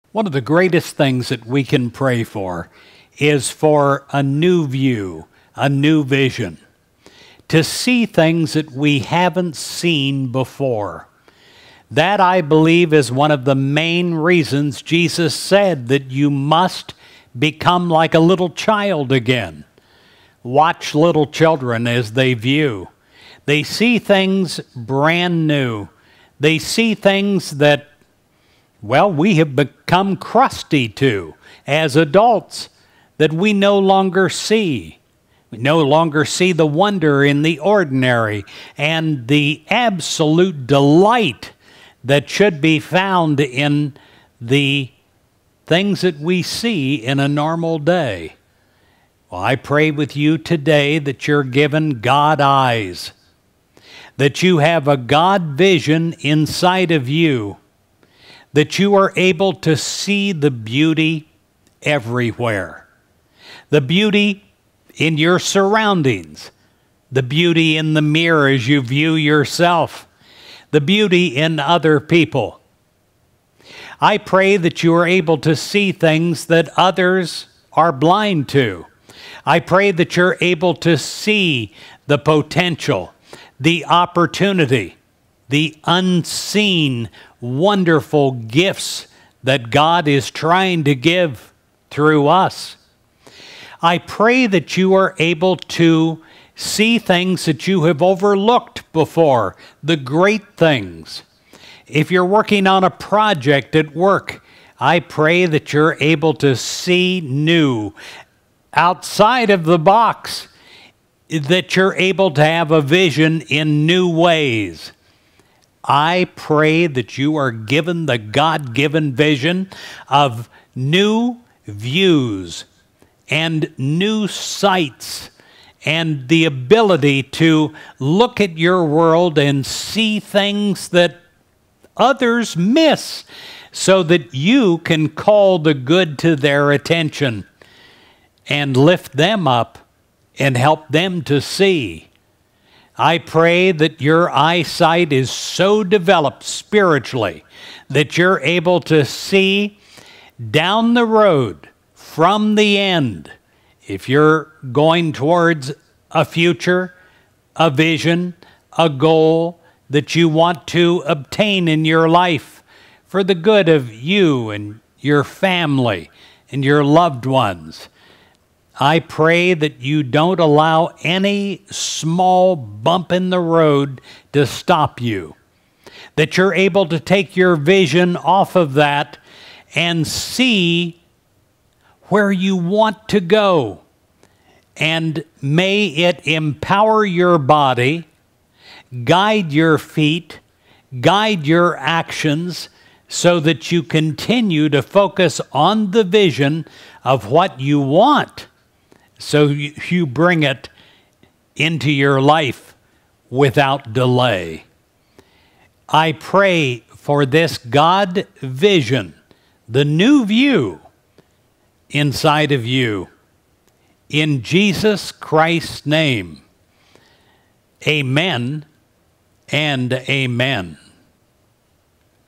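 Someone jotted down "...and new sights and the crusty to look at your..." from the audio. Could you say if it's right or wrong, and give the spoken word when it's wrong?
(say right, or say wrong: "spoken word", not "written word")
wrong: "ability", not "crusty".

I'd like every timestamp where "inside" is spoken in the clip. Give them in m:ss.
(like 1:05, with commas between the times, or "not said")
0:56, 3:31.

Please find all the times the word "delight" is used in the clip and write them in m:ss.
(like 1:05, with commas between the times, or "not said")
0:40.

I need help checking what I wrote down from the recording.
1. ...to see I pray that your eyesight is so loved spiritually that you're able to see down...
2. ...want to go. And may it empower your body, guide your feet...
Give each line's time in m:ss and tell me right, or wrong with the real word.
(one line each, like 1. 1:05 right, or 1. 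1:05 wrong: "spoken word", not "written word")
1. 2:21 wrong: "developed", not "loved"
2. 3:02 right.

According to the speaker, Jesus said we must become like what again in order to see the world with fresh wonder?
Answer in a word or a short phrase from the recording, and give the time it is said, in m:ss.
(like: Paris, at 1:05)
A little child, at 0:18.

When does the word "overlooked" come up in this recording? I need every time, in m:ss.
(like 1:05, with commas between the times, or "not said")
1:38.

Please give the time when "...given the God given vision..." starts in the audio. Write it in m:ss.
1:57.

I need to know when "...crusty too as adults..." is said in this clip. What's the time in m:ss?
0:30.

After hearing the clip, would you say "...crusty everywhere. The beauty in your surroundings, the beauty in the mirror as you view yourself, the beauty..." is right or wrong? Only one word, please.
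wrong.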